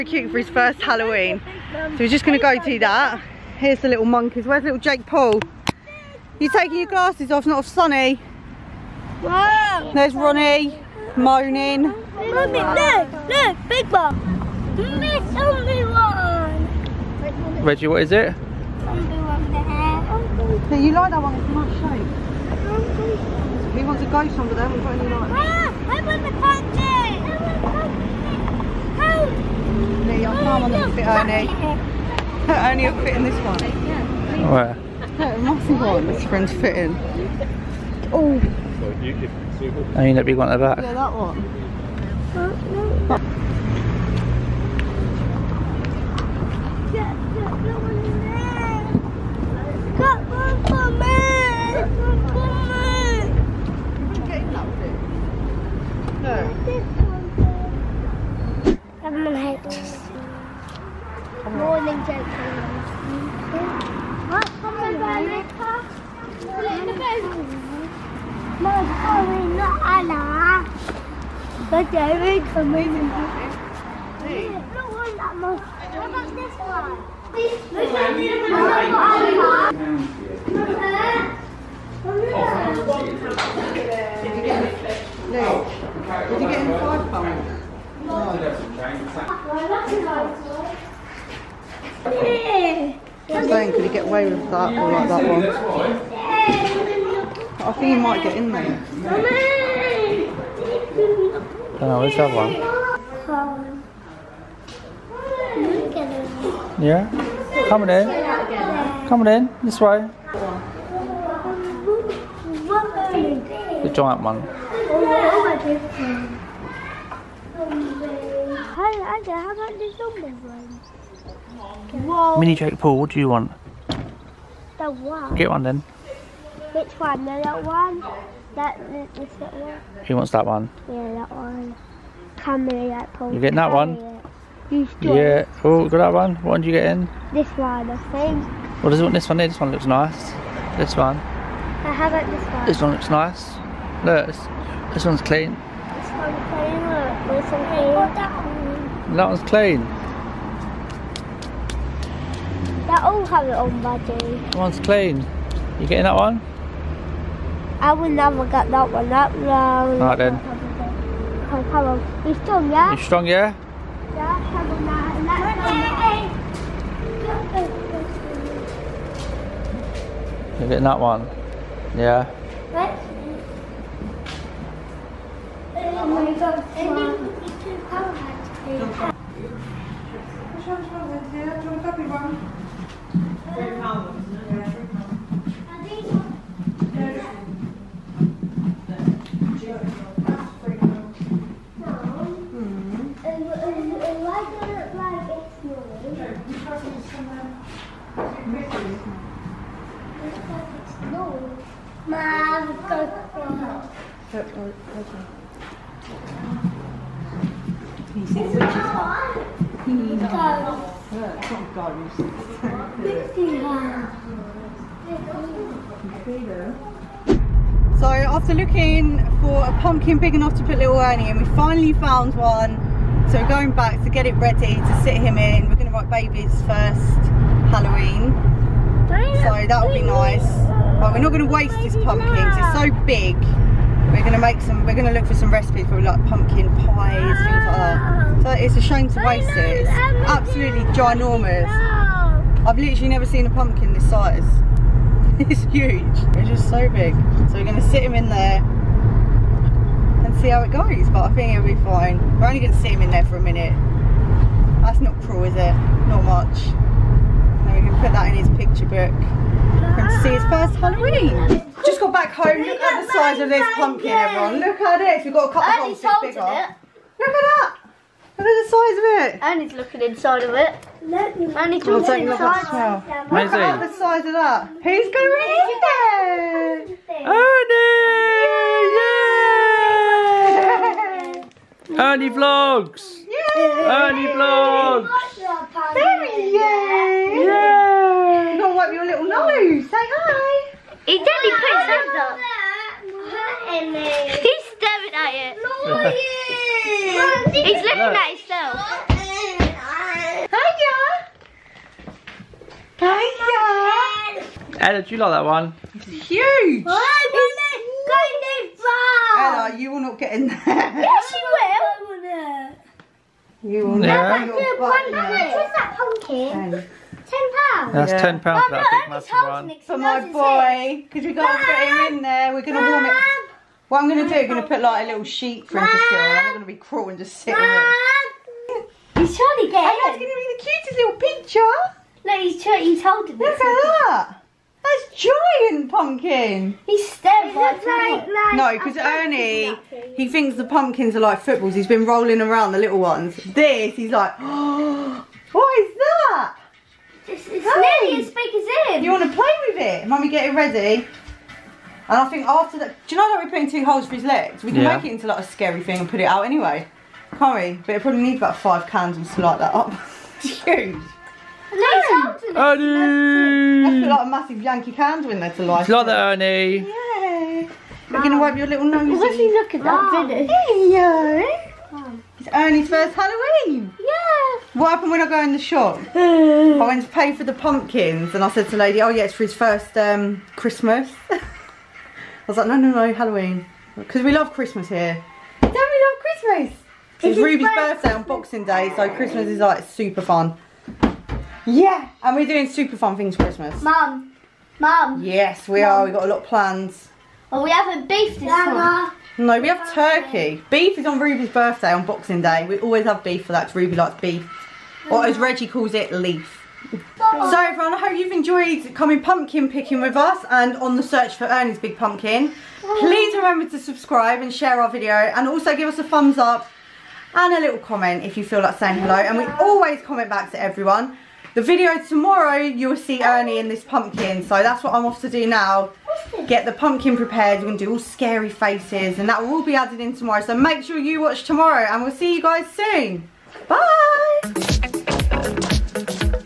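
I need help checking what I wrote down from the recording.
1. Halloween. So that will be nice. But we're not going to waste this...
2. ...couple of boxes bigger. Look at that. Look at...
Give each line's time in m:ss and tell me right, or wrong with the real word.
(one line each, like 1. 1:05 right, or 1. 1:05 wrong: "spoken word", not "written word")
1. 3:47 right
2. 4:25 right.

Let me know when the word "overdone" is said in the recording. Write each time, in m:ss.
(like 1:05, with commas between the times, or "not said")
not said.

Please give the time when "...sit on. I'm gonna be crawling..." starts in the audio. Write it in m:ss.
5:26.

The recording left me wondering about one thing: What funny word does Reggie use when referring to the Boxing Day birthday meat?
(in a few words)
Leaf.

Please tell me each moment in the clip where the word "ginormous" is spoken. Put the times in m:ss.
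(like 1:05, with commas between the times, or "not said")
4:00.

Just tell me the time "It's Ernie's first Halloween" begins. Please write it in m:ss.
6:12.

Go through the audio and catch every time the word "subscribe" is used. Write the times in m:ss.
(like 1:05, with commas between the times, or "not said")
6:53.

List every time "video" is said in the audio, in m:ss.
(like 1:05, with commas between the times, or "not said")
6:54, 7:01.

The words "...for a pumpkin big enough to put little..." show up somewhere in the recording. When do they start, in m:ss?
3:39.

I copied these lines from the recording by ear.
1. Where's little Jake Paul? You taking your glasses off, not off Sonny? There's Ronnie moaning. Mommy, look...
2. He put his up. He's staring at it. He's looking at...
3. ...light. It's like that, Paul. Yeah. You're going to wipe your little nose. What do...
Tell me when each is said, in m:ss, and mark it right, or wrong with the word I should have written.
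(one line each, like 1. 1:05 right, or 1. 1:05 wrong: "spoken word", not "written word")
1. 0:04 right
2. 4:51 right
3. 6:05 wrong: "Ernie", not "Paul".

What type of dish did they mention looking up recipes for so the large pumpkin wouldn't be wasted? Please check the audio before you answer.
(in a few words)
Pumpkin pies.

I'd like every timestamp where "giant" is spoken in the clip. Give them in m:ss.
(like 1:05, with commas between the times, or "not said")
1:53, 5:35.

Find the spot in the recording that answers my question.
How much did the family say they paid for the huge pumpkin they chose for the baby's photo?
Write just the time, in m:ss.
5:18.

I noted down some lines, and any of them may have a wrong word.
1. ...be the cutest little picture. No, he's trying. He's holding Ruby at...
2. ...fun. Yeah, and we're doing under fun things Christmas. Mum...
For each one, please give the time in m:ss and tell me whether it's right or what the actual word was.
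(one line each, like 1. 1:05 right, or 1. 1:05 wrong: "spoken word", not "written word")
1. 5:30 wrong: "Look", not "Ruby"
2. 6:30 wrong: "super", not "under".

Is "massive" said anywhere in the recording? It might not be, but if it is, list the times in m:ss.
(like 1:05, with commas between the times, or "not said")
0:35, 5:19, 6:04.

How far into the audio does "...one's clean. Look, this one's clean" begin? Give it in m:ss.
2:26.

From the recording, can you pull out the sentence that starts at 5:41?
He's been rolling around the little ones.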